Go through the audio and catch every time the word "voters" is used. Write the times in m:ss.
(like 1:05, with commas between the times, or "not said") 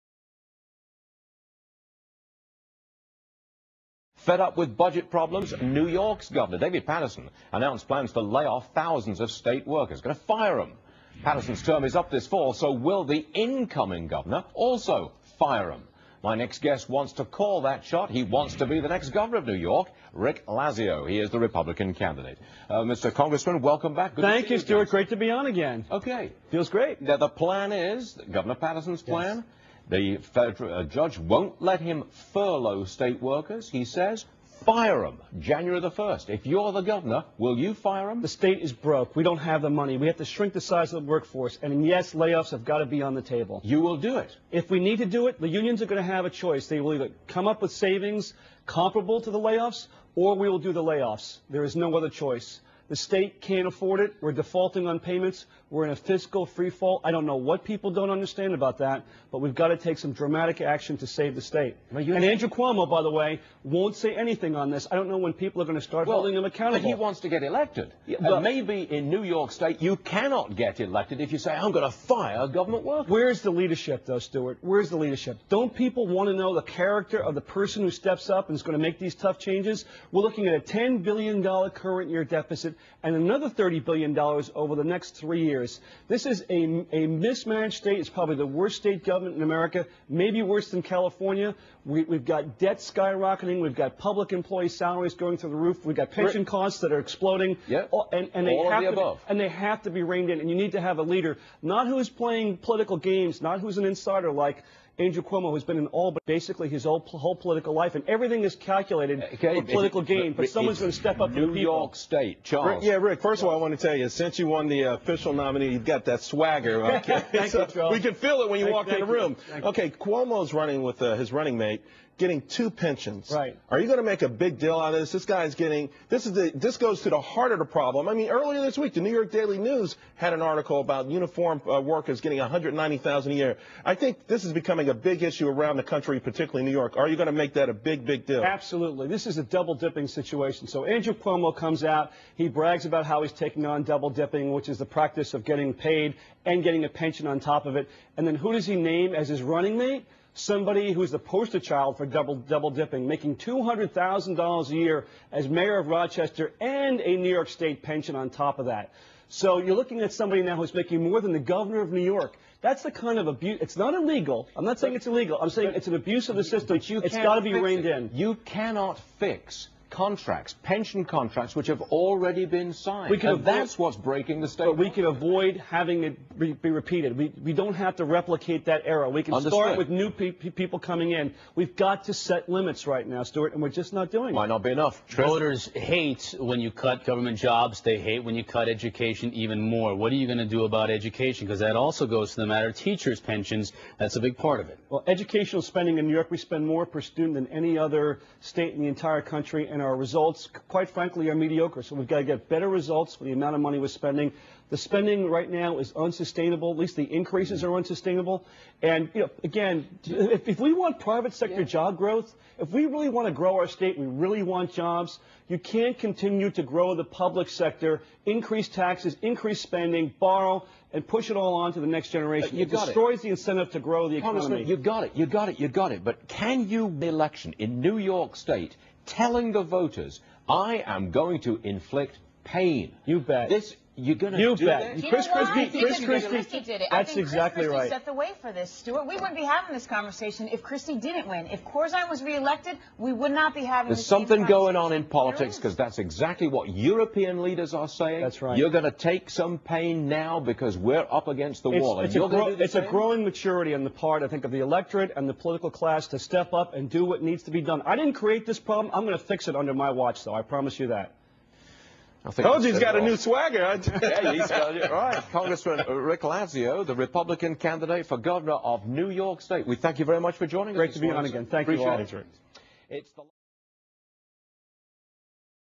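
3:05, 3:49.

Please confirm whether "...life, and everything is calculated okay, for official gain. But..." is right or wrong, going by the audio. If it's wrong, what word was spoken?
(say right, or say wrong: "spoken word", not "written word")
wrong: "political", not "official".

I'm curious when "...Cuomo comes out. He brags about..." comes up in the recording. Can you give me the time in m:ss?
2:21.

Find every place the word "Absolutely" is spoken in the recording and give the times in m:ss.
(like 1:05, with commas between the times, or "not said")
2:18.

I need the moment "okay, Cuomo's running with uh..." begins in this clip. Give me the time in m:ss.
1:59.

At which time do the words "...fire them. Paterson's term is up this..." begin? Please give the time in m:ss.
0:10.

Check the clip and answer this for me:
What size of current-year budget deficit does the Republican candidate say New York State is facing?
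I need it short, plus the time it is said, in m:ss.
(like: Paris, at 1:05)
$10 billion, at 1:20.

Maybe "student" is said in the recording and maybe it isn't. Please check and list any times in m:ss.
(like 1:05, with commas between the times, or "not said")
3:17.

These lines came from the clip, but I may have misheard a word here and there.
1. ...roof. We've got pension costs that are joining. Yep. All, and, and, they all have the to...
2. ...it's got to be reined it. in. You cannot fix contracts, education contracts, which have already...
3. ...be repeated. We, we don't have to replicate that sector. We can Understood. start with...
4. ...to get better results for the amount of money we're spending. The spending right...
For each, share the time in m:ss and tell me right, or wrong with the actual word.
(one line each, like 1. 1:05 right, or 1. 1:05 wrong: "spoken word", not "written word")
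1. 1:35 wrong: "exploding", not "joining"
2. 2:47 wrong: "pension", not "education"
3. 2:56 wrong: "error", not "sector"
4. 3:22 right.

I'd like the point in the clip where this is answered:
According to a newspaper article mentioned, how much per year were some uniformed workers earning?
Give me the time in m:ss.
2:12.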